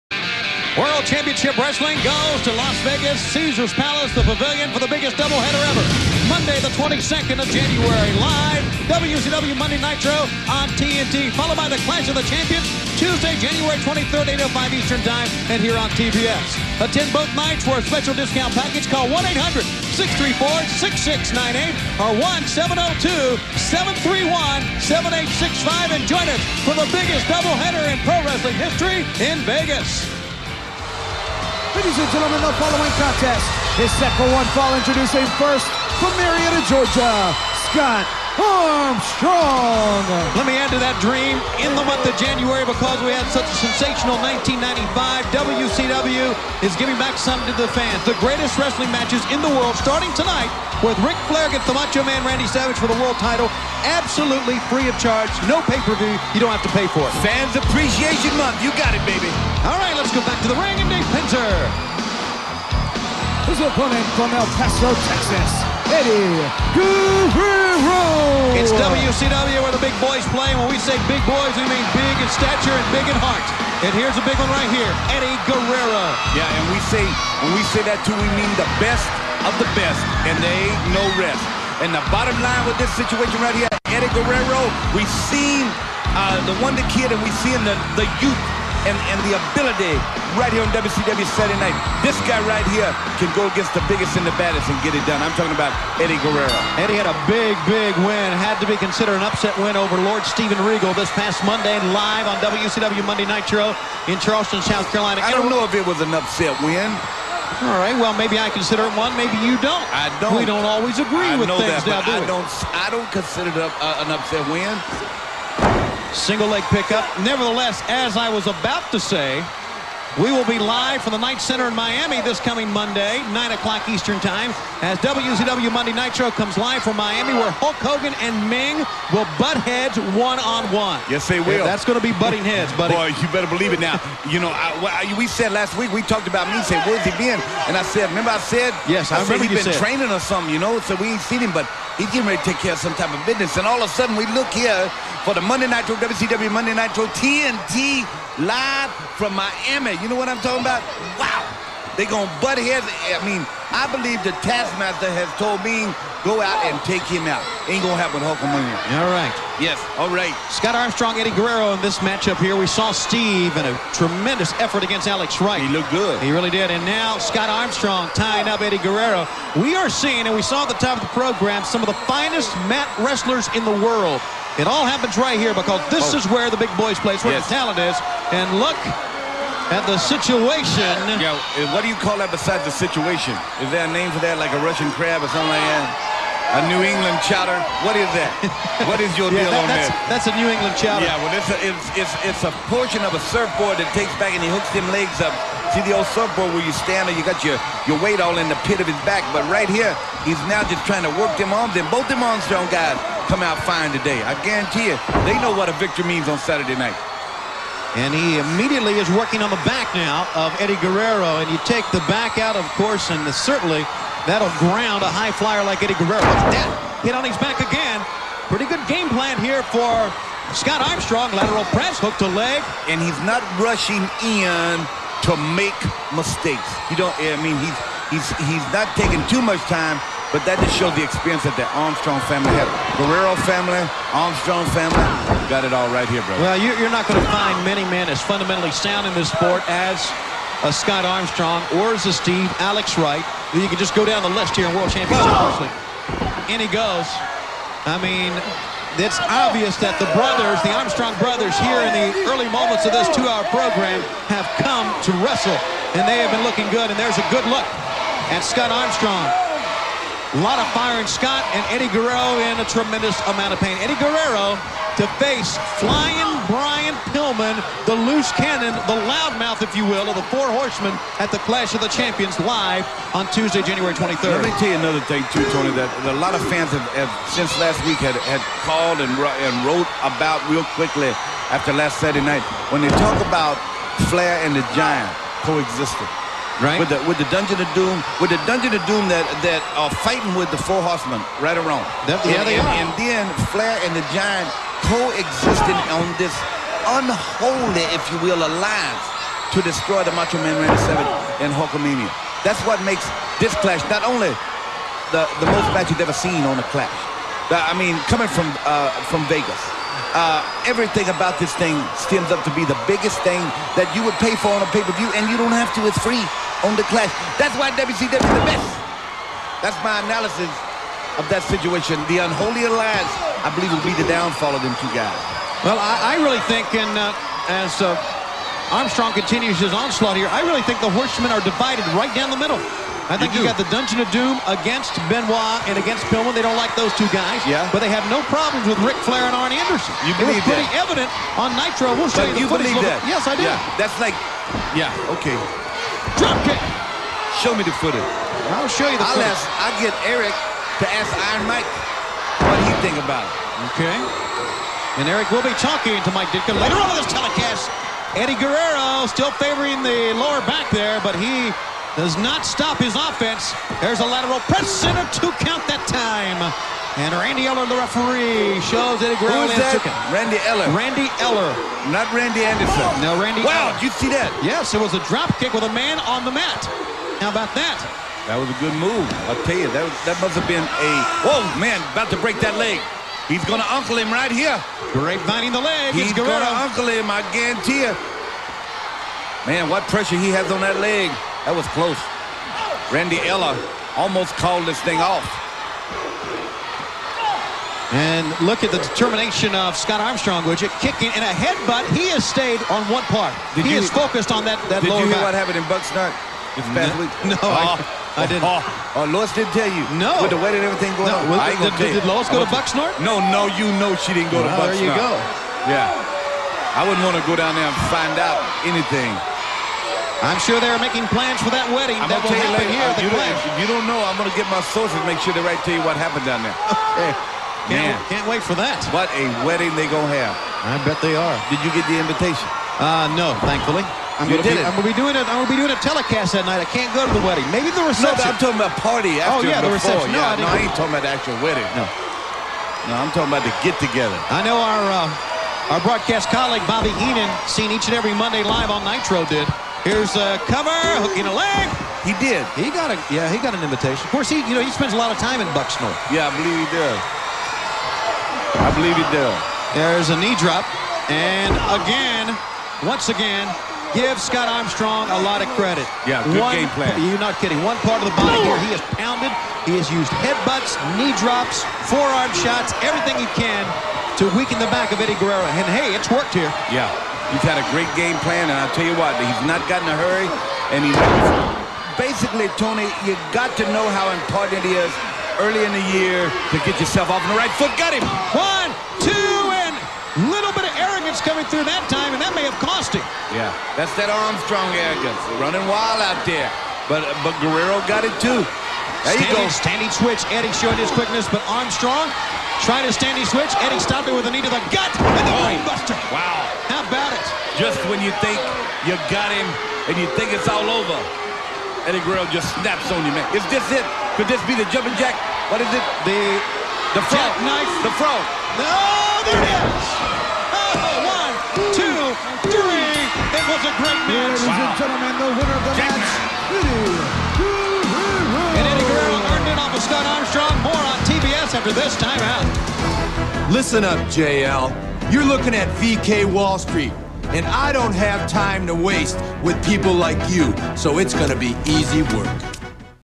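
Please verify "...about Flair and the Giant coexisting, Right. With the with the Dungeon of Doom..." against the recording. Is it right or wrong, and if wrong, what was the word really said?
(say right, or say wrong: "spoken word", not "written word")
right.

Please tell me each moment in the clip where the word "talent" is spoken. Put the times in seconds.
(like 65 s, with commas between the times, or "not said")
177 s.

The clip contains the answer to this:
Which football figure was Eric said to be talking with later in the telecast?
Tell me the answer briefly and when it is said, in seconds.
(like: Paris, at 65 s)
Mike Ditka, at 356 s.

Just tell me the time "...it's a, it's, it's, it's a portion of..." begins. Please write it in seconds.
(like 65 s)
191 s.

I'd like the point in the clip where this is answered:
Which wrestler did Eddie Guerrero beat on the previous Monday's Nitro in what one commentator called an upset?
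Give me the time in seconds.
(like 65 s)
100 s.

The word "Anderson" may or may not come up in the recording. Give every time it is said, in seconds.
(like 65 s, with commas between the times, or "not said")
339 s, 372 s.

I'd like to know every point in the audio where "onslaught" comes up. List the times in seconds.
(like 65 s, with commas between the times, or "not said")
329 s.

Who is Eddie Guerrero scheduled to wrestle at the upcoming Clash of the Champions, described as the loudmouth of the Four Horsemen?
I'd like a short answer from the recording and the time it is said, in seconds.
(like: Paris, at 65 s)
Brian Pillman, at 266 s.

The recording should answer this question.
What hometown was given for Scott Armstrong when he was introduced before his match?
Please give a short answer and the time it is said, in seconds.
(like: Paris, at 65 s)
Marietta, Georgia, at 36 s.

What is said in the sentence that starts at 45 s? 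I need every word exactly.
WCW is giving back something to the fans.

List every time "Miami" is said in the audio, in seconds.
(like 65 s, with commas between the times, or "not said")
121 s, 126 s, 149 s.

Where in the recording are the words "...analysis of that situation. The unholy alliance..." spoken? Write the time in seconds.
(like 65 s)
320 s.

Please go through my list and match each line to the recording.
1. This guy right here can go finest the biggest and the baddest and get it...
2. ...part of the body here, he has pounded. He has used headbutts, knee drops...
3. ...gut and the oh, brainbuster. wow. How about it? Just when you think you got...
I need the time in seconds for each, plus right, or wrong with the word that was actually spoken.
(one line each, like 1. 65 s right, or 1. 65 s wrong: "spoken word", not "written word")
1. 92 s wrong: "against", not "finest"
2. 467 s right
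3. 504 s right.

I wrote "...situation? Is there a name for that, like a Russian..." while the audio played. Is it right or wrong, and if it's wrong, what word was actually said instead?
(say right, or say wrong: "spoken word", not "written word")
right.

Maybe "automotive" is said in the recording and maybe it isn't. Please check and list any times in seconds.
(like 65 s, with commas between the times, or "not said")
not said.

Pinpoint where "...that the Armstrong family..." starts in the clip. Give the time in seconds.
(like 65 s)
231 s.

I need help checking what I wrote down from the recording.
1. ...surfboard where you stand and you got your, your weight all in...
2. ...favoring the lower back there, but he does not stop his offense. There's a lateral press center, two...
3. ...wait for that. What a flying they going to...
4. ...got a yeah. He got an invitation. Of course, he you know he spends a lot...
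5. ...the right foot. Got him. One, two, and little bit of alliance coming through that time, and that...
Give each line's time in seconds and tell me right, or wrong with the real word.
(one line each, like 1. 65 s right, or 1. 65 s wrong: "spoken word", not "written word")
1. 196 s right
2. 359 s right
3. 428 s wrong: "wedding", not "flying"
4. 452 s right
5. 487 s wrong: "arrogance", not "alliance".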